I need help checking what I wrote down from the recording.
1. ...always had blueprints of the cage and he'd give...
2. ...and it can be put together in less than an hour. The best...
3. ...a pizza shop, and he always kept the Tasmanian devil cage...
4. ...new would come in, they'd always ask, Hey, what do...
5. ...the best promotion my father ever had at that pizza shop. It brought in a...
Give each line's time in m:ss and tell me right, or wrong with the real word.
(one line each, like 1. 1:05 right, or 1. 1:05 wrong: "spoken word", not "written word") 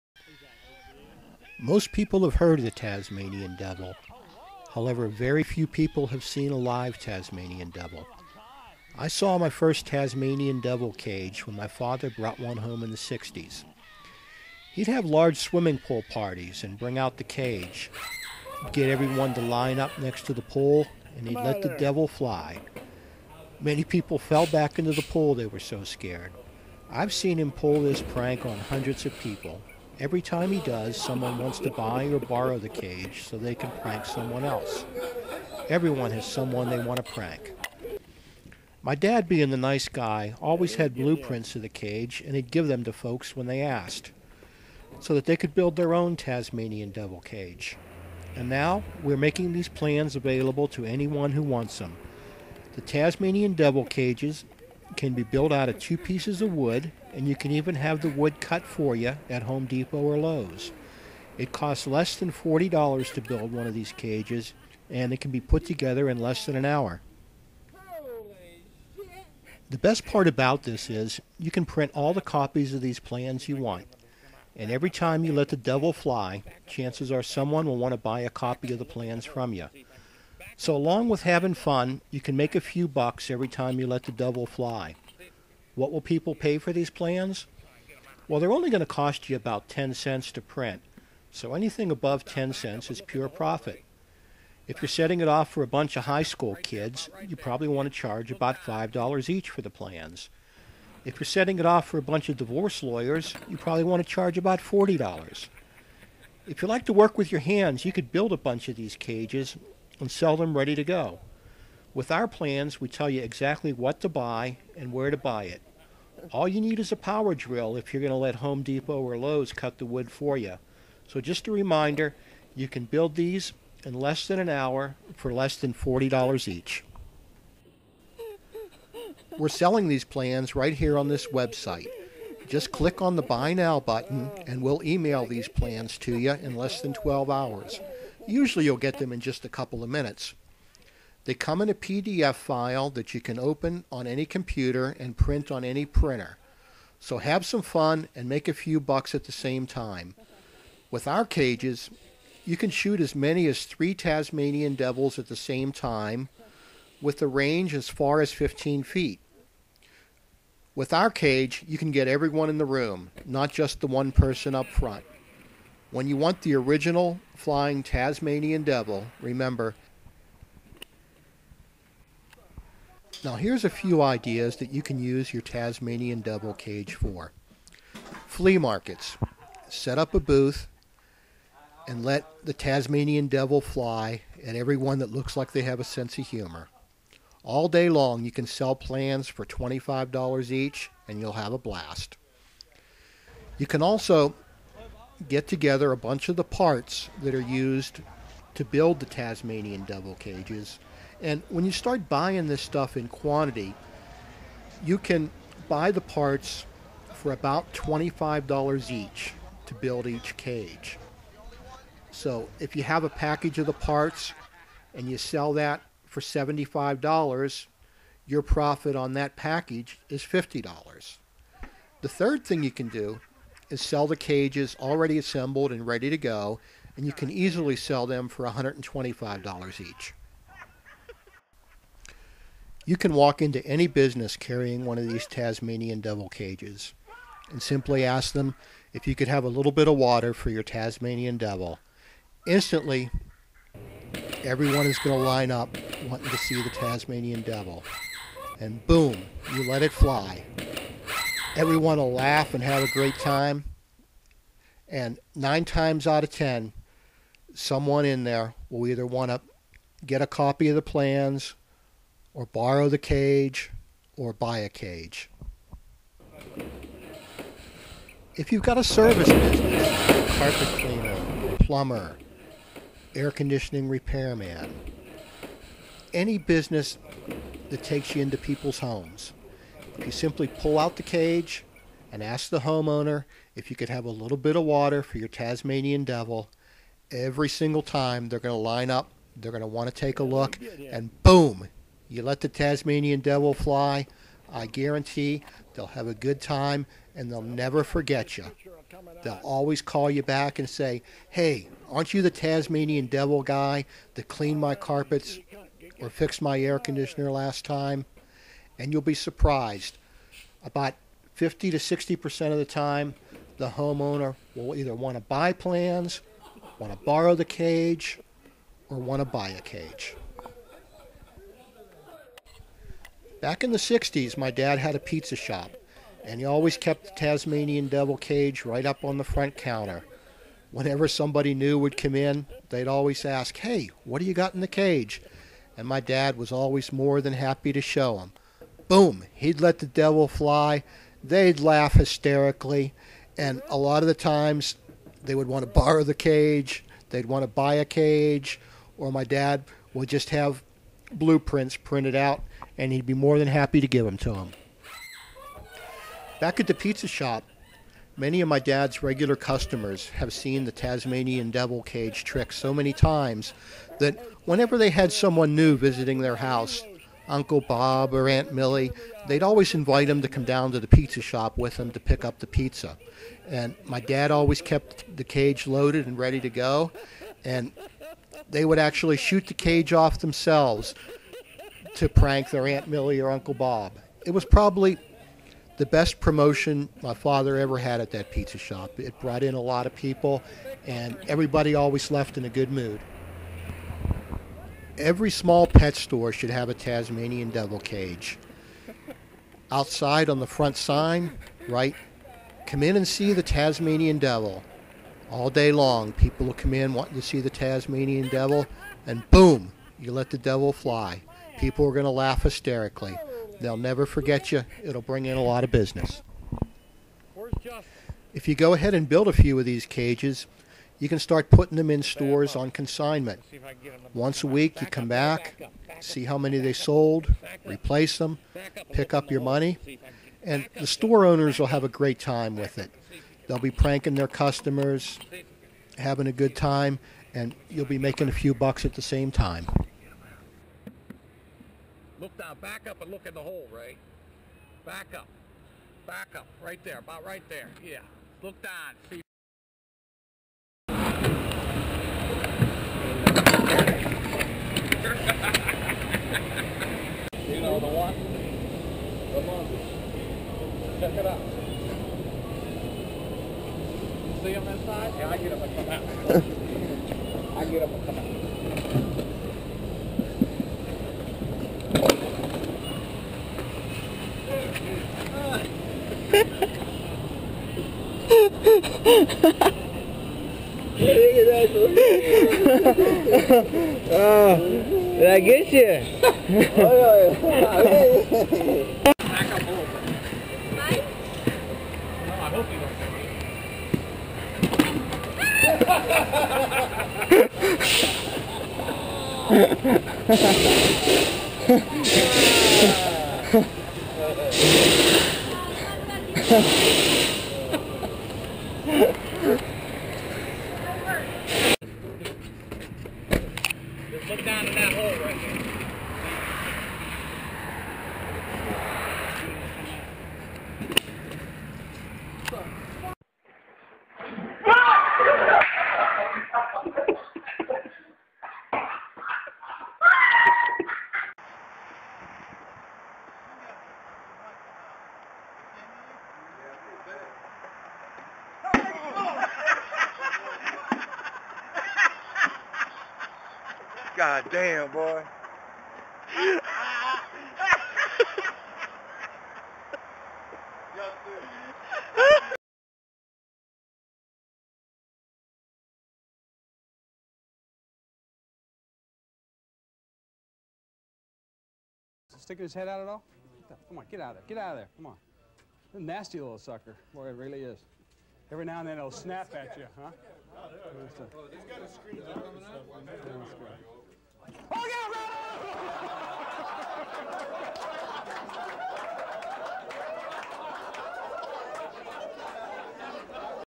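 1. 0:40 right
2. 1:04 right
3. 5:24 right
4. 5:31 right
5. 6:25 right.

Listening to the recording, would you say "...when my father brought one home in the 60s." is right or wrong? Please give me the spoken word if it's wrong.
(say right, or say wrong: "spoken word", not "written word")
right.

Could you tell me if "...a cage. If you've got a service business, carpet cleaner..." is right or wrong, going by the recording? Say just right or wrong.
right.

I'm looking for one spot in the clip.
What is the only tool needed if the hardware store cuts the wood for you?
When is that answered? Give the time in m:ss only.
1:56.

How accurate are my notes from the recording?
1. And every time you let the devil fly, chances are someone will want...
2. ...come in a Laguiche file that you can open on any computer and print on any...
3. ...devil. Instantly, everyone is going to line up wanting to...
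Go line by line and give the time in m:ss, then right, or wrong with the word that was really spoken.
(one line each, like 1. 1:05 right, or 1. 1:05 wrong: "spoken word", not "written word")
1. 1:14 right
2. 2:21 wrong: "PDF", not "Laguiche"
3. 4:01 right.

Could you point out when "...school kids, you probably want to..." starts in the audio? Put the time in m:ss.
1:36.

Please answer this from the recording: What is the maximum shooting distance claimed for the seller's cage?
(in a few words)
15 feet.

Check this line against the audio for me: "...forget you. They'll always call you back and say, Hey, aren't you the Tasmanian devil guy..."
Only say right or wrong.
right.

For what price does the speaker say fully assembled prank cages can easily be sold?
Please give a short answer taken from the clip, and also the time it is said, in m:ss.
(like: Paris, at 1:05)
$125, at 3:48.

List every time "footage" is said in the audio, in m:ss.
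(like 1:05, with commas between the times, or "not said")
not said.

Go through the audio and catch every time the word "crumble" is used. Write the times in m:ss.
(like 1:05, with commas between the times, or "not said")
not said.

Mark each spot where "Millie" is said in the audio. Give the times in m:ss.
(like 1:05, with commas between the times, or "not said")
6:08, 6:22.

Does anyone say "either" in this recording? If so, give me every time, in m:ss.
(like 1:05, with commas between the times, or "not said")
4:18, 5:14.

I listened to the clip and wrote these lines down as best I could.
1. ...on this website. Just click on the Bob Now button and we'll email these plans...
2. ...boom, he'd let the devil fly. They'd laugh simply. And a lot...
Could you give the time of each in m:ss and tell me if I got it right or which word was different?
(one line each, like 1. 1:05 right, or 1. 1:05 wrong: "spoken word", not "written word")
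1. 2:10 wrong: "Buy", not "Bob"
2. 5:38 wrong: "hysterically", not "simply".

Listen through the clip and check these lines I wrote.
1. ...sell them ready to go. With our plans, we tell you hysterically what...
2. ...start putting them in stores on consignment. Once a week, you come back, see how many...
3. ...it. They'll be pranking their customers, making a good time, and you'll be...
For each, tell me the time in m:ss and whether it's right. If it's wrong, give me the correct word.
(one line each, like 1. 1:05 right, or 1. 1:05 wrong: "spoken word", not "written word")
1. 1:50 wrong: "exactly", not "hysterically"
2. 7:01 right
3. 7:12 wrong: "having", not "making".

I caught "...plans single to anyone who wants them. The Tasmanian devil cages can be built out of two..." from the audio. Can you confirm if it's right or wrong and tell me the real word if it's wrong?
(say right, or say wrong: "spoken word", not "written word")
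wrong: "available", not "single".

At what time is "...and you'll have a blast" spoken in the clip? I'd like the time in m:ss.
3:11.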